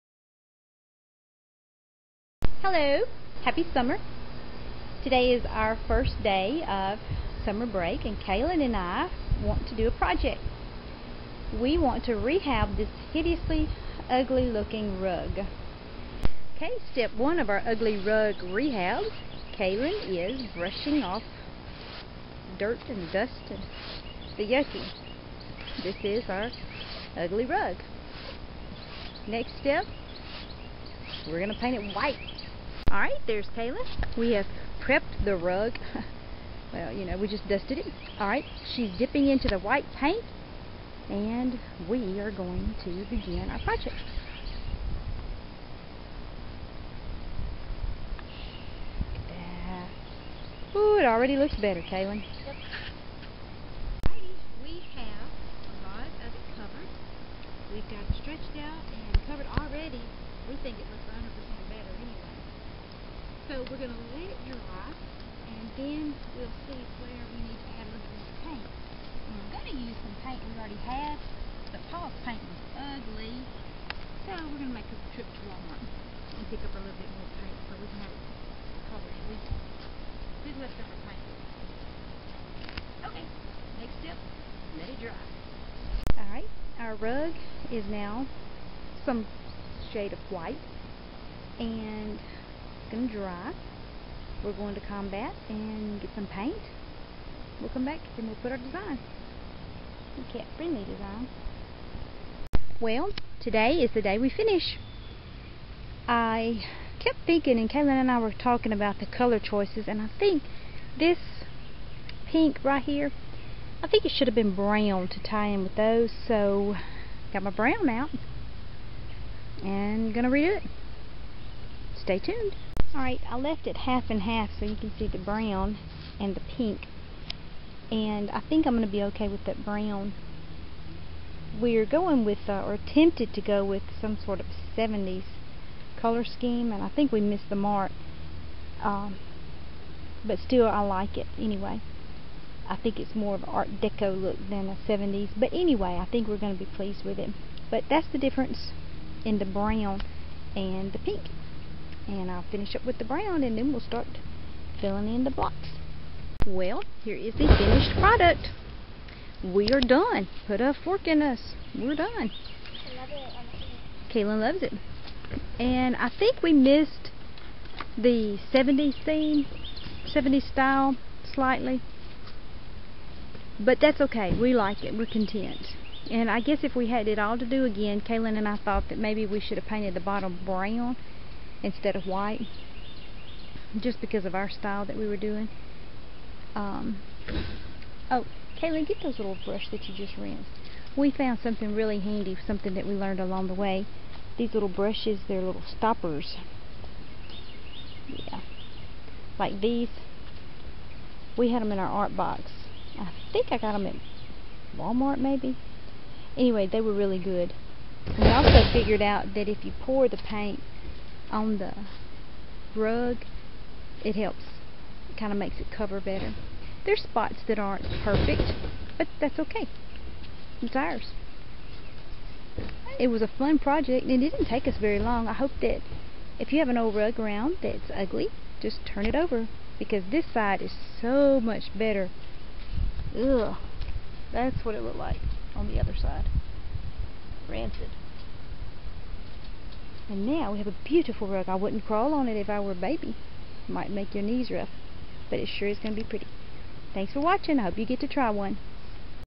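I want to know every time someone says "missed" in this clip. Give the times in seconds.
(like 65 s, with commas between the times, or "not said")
137 s, 166 s.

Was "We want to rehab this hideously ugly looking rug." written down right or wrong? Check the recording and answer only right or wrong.
right.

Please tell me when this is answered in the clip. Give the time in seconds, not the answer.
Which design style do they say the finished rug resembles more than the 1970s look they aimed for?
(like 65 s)
143 s.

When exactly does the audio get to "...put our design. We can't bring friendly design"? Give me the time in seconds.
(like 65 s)
98 s.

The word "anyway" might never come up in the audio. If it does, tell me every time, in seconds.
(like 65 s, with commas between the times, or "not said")
141 s, 145 s, 206 s.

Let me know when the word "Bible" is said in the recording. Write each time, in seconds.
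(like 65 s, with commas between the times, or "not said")
not said.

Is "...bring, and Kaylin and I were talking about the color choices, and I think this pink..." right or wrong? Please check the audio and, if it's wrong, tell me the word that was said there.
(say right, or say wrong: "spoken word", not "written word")
wrong: "thinking", not "bring".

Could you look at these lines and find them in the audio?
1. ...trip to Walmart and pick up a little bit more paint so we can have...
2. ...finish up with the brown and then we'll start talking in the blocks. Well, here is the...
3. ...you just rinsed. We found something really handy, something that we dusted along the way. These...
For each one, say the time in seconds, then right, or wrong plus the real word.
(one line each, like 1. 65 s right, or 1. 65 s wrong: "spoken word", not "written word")
1. 75 s right
2. 152 s wrong: "filling", not "talking"
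3. 189 s wrong: "learned", not "dusted".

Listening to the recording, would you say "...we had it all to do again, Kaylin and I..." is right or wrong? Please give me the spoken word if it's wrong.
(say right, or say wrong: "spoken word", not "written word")
right.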